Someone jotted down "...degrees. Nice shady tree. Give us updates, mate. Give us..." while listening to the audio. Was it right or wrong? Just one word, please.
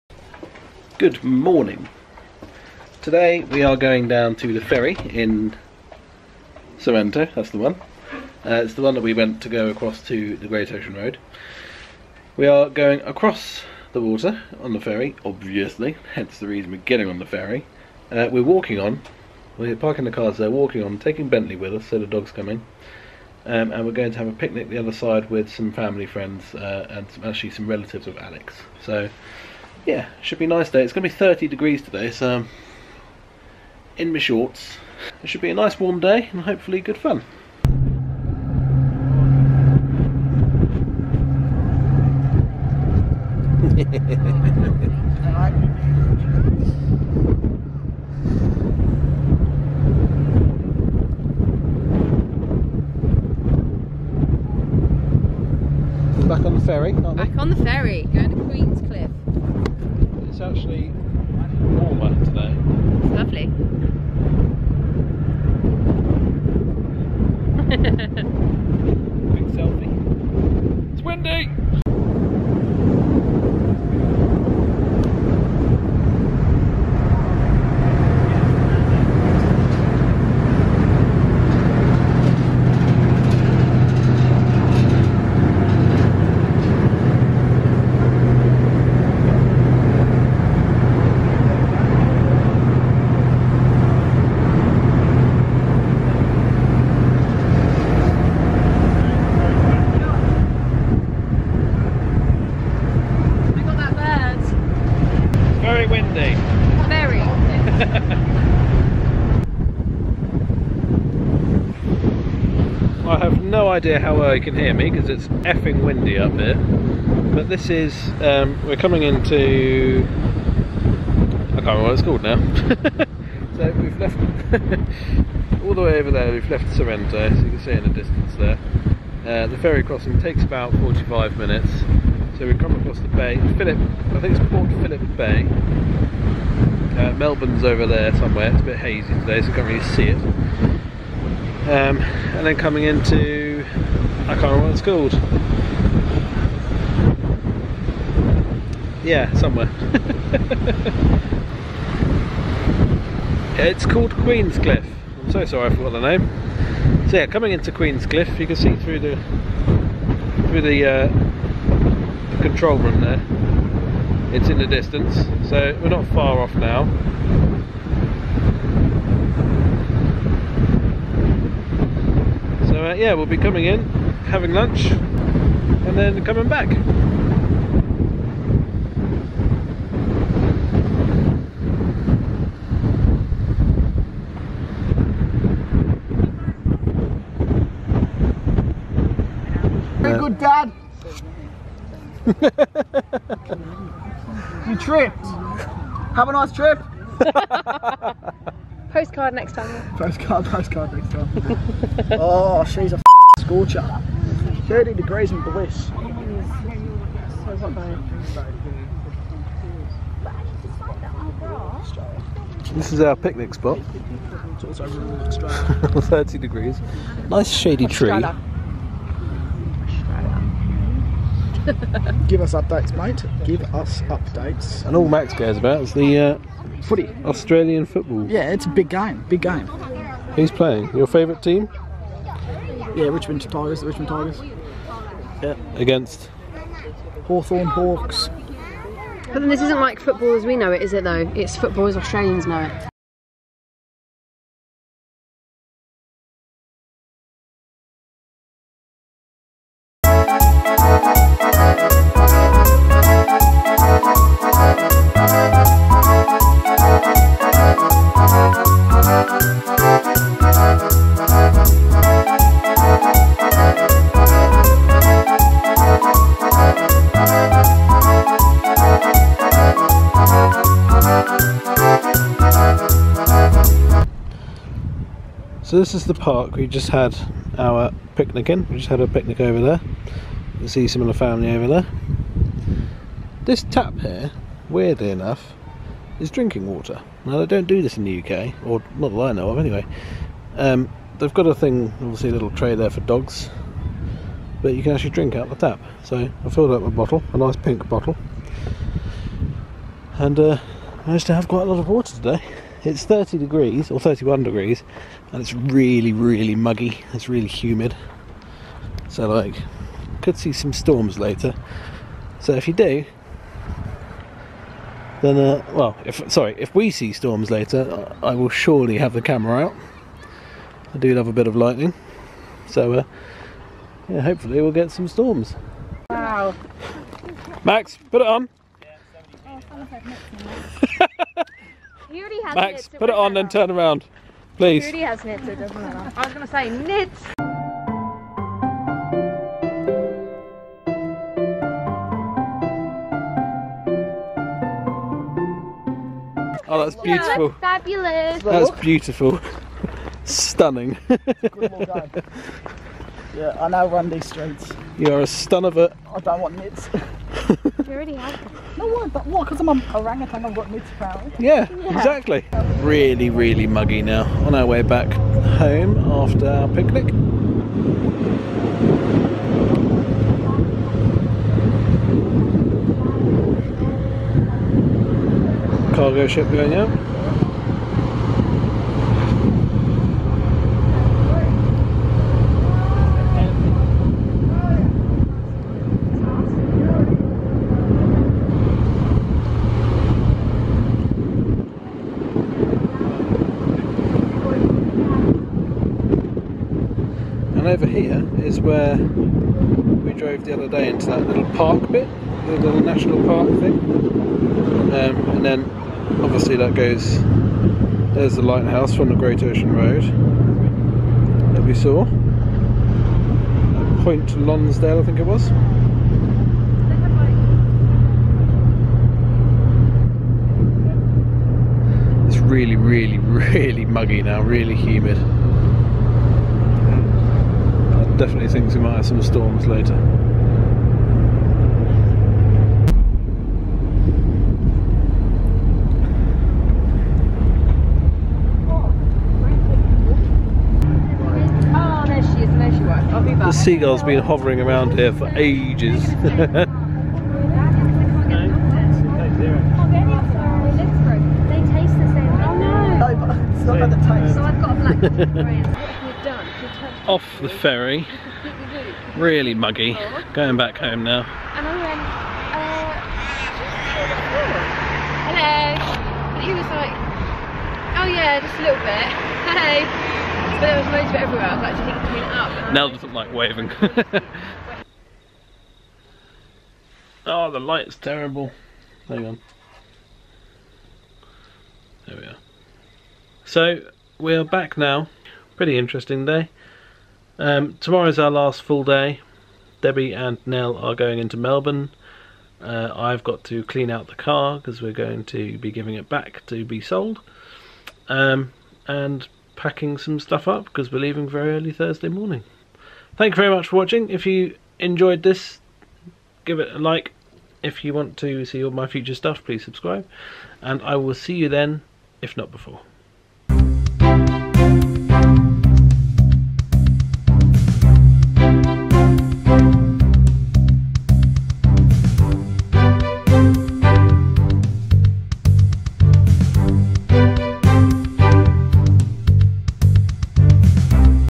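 right.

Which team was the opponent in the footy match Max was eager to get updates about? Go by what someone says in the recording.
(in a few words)
Hawthorn Hawks.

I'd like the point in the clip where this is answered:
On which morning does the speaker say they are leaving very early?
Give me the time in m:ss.
8:21.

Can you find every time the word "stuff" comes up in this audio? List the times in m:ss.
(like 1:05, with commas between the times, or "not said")
8:20, 8:29.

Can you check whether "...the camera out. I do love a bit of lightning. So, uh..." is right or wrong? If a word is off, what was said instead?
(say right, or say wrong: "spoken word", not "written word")
right.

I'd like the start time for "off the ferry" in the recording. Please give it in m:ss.
7:37.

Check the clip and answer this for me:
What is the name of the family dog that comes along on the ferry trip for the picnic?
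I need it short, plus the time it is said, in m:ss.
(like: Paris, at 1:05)
Bentley, at 0:21.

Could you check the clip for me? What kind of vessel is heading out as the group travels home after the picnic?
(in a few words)
Cargo ship.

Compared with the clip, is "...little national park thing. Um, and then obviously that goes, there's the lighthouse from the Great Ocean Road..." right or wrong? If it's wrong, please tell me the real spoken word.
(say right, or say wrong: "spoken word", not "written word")
right.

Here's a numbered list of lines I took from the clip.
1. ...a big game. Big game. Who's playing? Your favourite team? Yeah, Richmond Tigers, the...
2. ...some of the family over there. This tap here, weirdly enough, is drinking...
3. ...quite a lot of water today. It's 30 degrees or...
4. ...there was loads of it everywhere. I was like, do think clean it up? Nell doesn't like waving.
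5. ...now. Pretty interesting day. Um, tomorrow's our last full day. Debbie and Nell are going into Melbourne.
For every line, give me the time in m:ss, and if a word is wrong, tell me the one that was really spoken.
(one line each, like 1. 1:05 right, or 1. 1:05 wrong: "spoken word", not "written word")
1. 3:48 right
2. 4:40 right
3. 5:01 right
4. 7:50 right
5. 8:04 right.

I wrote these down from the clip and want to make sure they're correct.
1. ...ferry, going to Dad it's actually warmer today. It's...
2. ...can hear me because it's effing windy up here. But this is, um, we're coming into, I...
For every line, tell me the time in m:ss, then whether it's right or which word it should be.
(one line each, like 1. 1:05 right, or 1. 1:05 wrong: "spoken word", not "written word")
1. 0:57 wrong: "Queenscliff", not "Dad"
2. 1:54 right.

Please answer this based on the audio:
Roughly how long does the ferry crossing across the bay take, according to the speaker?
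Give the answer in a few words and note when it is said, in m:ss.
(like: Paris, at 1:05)
45 minutes, at 2:10.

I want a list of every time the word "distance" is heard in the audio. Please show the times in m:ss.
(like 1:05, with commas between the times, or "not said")
2:07, 2:44.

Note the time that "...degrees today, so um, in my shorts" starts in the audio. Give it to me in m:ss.
0:31.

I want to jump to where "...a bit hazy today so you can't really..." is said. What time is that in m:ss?
2:18.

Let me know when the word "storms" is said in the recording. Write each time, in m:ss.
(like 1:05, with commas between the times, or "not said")
5:10, 5:17, 5:25.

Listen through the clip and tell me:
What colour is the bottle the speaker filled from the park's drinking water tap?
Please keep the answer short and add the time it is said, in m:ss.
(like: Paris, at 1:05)
Pink, at 4:57.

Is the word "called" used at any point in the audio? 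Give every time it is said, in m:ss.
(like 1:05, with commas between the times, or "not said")
2:02, 2:24, 2:33.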